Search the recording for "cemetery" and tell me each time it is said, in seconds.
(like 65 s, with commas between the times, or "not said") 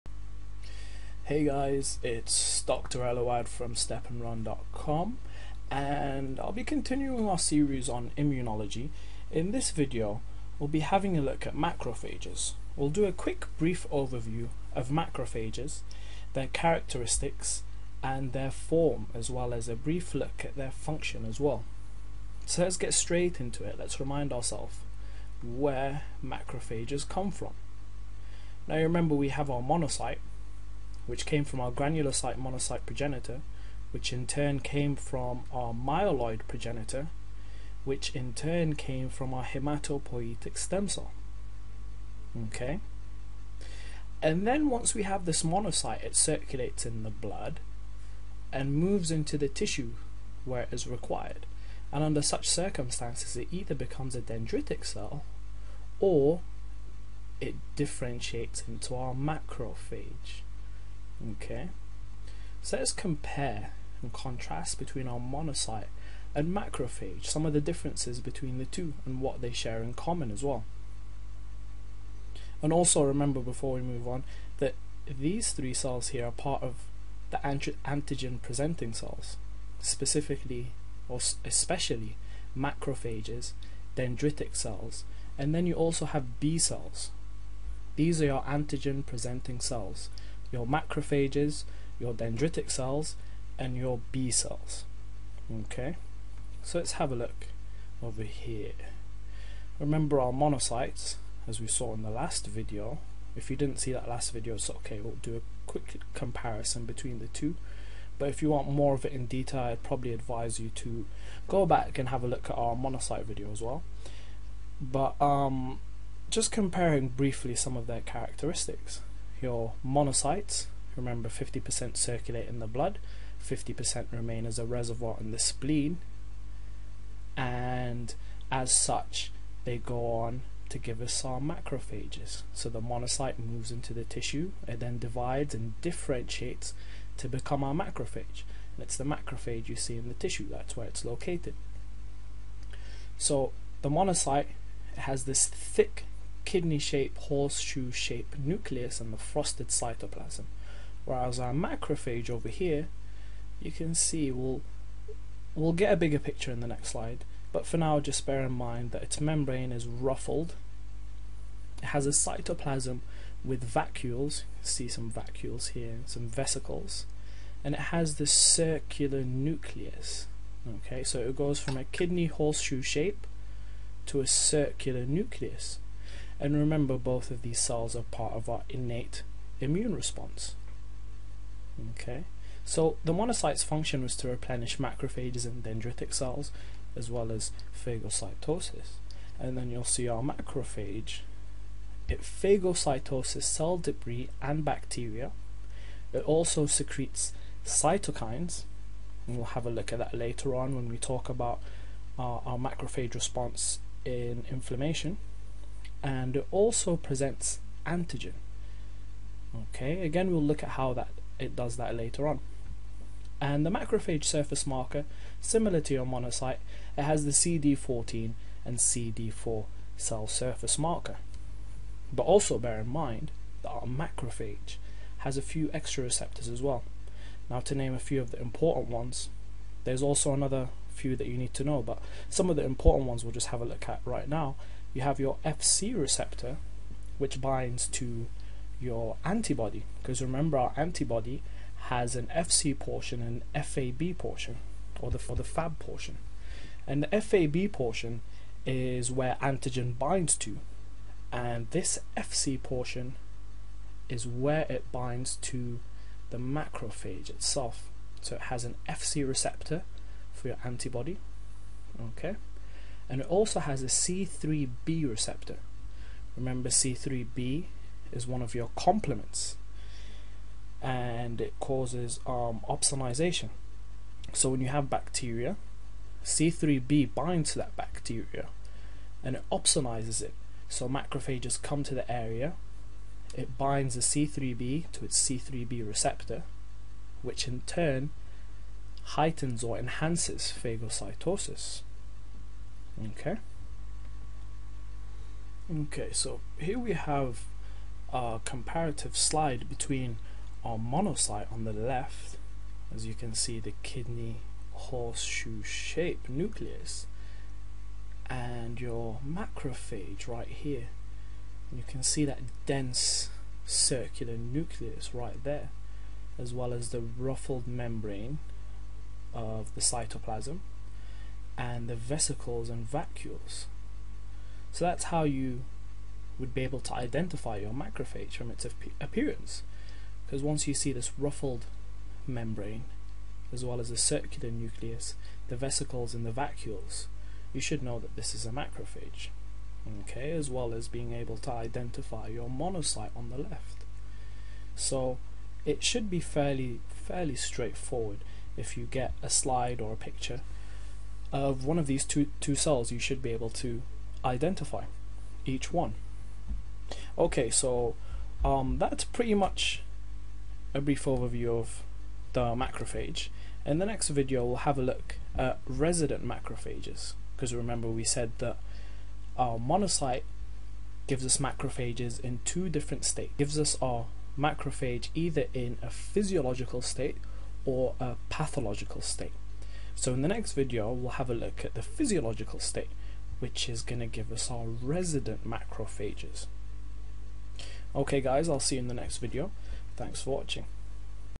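not said.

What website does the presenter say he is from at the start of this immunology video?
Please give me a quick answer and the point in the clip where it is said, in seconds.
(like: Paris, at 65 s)
stepnrun.com, at 3 s.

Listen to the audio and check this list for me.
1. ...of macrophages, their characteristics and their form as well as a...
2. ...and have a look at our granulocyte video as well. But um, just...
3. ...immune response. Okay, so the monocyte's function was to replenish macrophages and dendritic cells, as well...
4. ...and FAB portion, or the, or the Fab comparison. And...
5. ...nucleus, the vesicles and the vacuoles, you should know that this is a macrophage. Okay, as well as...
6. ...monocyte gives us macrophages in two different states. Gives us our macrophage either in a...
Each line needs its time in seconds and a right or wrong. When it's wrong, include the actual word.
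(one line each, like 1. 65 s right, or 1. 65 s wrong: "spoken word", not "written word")
1. 14 s right
2. 111 s wrong: "monocyte", not "granulocyte"
3. 179 s right
4. 243 s wrong: "portion", not "comparison"
5. 334 s right
6. 369 s right.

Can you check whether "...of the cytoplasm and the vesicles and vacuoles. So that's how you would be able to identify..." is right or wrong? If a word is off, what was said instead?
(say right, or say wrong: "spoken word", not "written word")
right.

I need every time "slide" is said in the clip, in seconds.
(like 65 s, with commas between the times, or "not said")
156 s, 299 s, 349 s.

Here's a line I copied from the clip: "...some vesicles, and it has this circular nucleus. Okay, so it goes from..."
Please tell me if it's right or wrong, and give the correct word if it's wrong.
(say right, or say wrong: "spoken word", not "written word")
right.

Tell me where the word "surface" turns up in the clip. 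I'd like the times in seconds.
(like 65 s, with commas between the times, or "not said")
214 s, 220 s.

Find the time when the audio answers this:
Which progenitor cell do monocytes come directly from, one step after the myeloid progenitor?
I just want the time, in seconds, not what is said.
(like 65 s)
31 s.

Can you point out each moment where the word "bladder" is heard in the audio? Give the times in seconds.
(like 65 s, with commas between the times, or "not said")
not said.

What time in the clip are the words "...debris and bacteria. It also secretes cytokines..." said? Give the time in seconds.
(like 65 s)
193 s.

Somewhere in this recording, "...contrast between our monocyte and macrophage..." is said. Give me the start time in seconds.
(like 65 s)
64 s.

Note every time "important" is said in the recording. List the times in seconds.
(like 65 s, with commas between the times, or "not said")
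228 s, 232 s.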